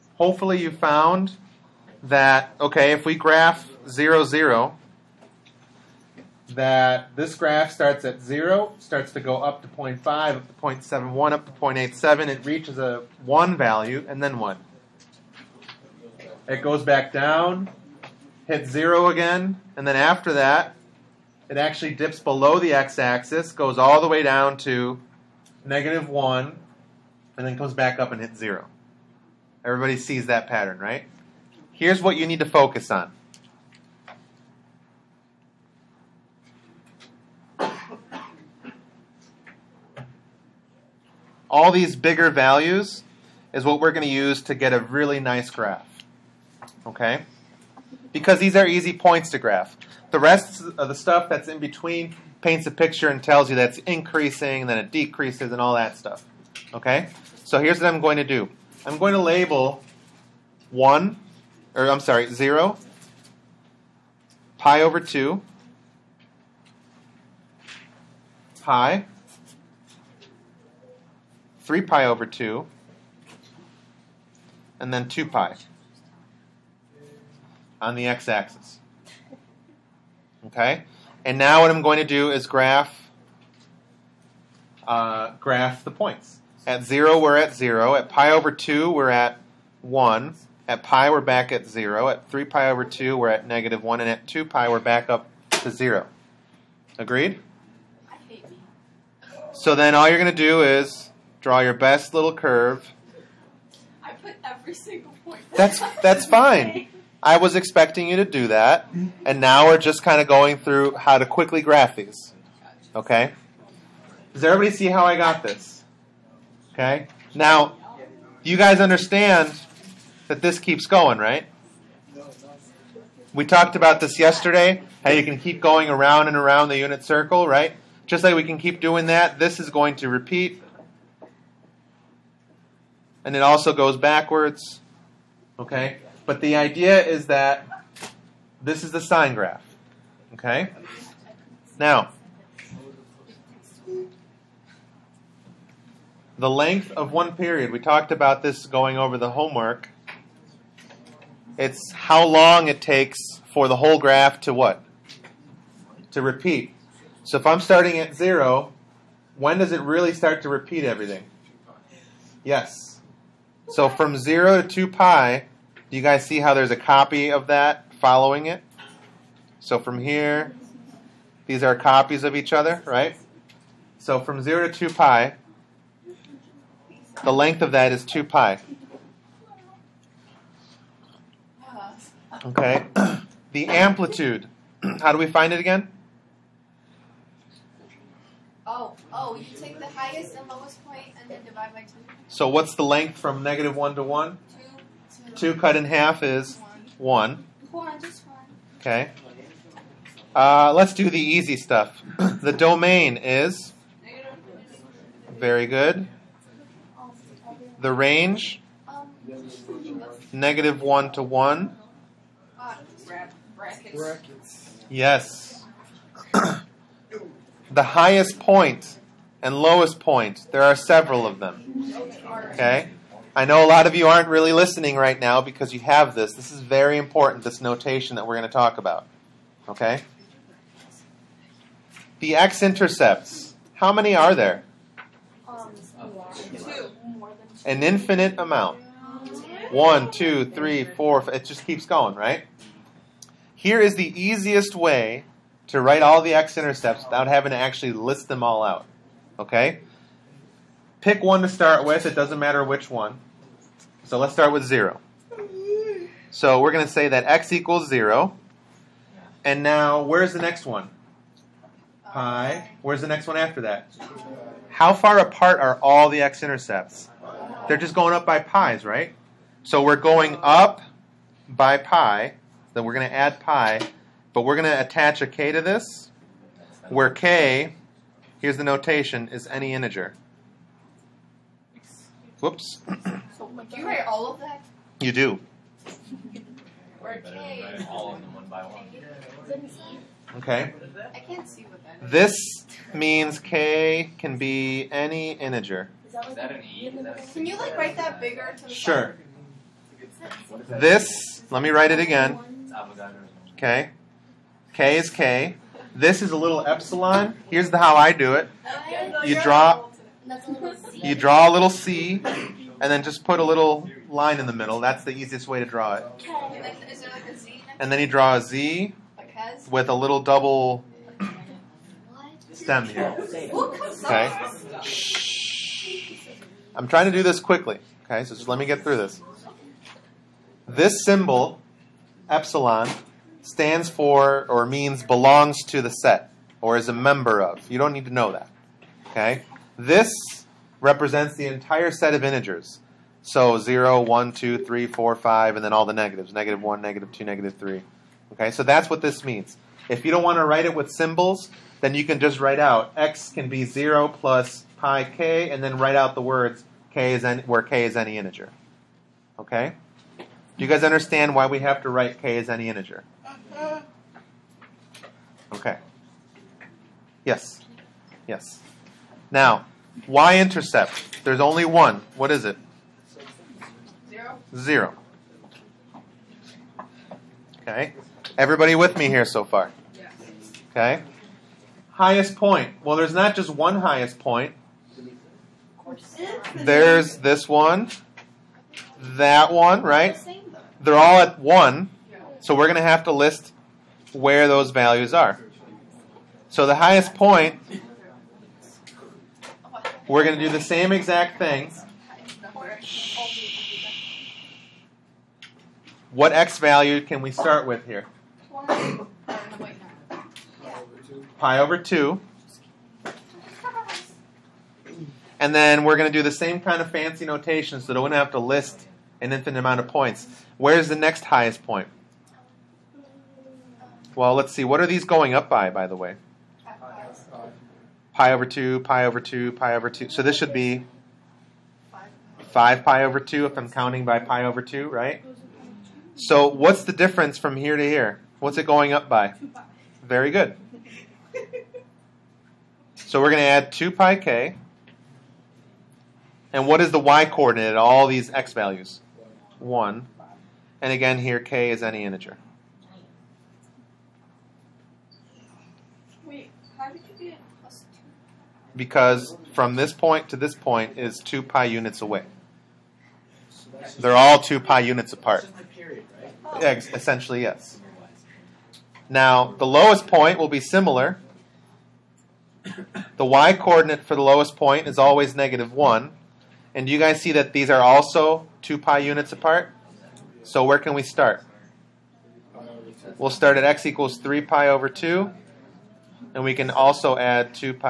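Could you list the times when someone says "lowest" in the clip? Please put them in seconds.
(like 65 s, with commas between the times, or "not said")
190 s, 219 s, 469 s, 474 s.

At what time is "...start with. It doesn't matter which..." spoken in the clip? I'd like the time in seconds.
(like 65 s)
251 s.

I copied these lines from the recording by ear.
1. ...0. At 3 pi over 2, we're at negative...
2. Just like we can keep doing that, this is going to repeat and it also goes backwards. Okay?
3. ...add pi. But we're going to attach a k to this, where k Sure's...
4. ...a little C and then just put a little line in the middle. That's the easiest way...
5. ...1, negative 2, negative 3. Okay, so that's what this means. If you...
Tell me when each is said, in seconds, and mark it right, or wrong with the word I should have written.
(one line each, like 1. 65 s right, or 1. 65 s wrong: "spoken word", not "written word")
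1. 91 s right
2. 128 s right
3. 273 s wrong: "Here", not "Sure"
4. 311 s right
5. 346 s right.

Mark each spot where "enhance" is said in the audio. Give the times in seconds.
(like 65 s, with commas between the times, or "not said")
not said.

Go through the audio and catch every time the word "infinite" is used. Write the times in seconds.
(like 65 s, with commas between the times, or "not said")
237 s, 419 s.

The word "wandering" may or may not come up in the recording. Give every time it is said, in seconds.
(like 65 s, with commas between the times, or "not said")
not said.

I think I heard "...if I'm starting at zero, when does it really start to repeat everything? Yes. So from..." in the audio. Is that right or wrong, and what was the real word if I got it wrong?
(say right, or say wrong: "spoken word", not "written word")
right.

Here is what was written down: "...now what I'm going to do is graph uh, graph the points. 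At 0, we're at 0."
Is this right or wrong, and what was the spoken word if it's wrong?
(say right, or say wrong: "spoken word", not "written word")
right.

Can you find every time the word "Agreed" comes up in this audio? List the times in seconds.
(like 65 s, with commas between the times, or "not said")
96 s.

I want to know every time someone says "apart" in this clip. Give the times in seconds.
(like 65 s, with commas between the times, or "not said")
265 s, 465 s, 479 s.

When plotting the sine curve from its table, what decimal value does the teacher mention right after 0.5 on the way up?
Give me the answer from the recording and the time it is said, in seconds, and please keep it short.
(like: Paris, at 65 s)
0.71, at 10 s.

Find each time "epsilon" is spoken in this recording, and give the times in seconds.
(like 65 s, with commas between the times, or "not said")
306 s, 332 s.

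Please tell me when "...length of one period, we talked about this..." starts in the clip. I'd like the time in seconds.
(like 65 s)
146 s.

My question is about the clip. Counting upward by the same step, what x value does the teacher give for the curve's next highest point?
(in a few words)
5pi/2.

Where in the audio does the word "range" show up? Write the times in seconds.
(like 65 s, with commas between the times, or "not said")
207 s.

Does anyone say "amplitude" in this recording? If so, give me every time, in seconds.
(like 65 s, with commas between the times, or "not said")
183 s.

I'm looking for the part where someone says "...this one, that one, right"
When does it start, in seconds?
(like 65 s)
387 s.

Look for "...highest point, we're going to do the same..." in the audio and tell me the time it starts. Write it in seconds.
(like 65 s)
396 s.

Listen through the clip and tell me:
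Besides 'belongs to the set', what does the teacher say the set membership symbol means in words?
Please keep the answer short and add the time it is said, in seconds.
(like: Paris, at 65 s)
is a member of, at 336 s.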